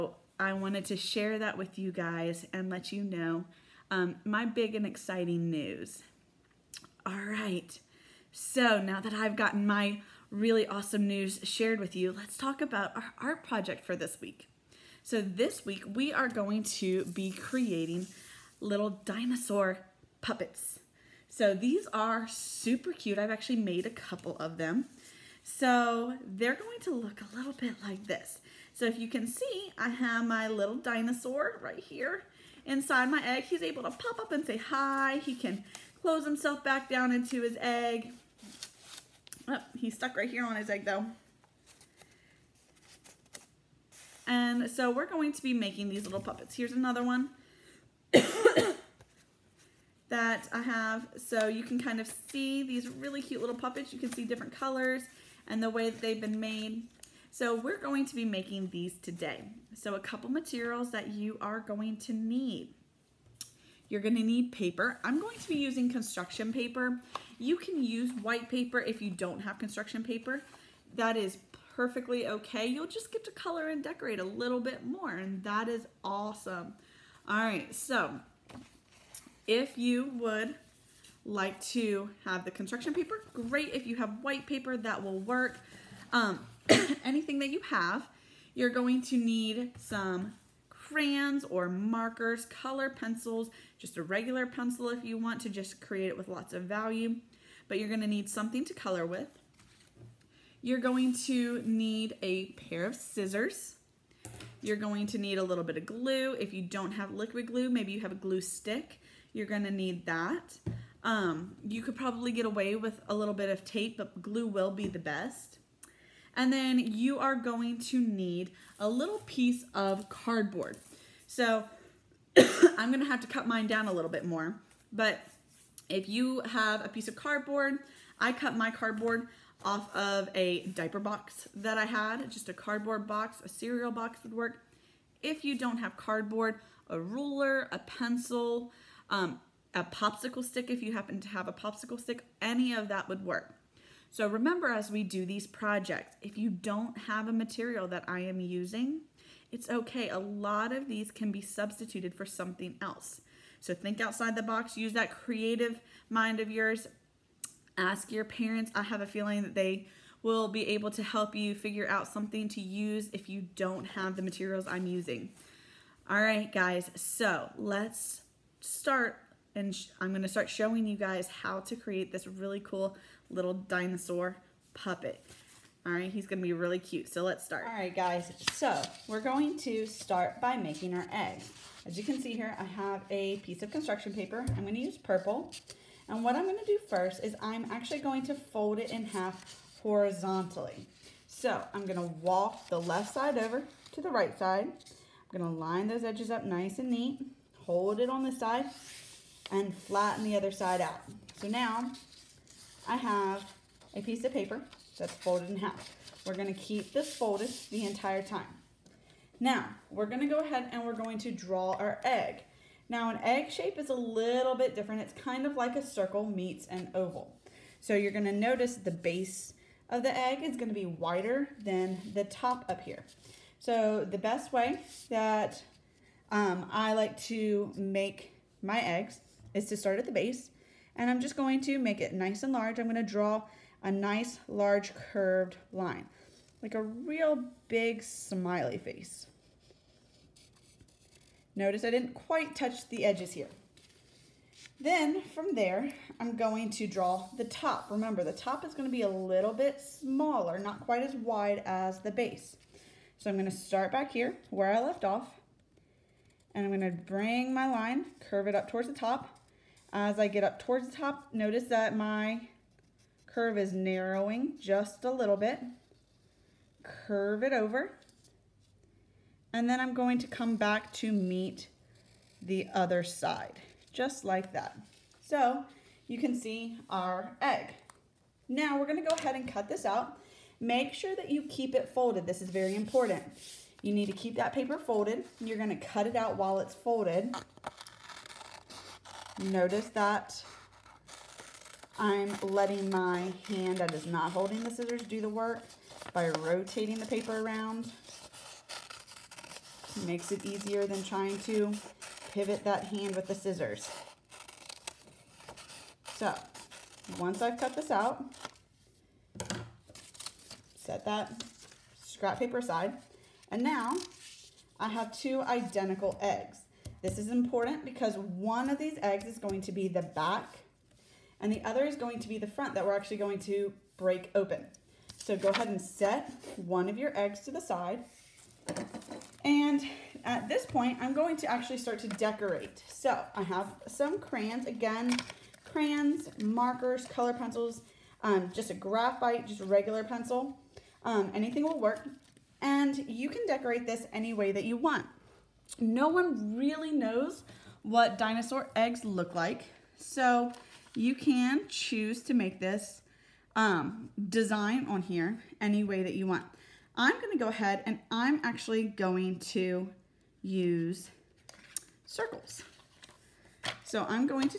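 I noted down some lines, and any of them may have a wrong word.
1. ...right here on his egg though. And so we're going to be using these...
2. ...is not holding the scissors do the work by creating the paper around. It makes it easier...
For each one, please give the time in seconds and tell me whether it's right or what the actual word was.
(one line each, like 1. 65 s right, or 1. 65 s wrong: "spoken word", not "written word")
1. 40 s wrong: "making", not "using"
2. 293 s wrong: "rotating", not "creating".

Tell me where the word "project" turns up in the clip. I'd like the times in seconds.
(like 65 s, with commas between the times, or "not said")
13 s, 145 s.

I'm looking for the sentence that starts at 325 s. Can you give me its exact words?
So go ahead and set one of your eggs to the side.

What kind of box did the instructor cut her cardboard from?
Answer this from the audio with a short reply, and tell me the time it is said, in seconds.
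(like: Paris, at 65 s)
diaper box, at 130 s.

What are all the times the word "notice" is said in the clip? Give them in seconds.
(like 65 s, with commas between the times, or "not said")
218 s, 241 s, 261 s, 289 s.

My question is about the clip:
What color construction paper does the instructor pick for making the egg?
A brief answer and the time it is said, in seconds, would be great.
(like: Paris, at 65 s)
purple, at 184 s.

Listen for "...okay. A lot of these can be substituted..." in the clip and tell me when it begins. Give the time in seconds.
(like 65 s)
149 s.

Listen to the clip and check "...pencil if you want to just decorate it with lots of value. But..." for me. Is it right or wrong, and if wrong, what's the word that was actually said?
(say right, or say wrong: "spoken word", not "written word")
wrong: "create", not "decorate".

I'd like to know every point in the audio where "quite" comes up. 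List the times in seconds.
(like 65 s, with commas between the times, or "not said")
242 s, 250 s.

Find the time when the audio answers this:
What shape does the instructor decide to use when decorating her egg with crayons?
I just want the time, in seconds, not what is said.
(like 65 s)
362 s.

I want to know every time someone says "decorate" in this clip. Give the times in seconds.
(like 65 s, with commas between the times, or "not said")
73 s, 332 s, 343 s.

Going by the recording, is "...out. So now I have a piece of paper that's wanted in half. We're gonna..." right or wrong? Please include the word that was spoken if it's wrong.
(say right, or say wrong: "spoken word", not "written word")
wrong: "folded", not "wanted".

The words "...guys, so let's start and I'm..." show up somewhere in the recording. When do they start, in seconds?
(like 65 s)
166 s.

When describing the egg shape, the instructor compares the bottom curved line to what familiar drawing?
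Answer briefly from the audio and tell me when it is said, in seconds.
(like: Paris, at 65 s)
big smiley face, at 236 s.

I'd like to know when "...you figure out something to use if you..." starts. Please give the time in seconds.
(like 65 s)
161 s.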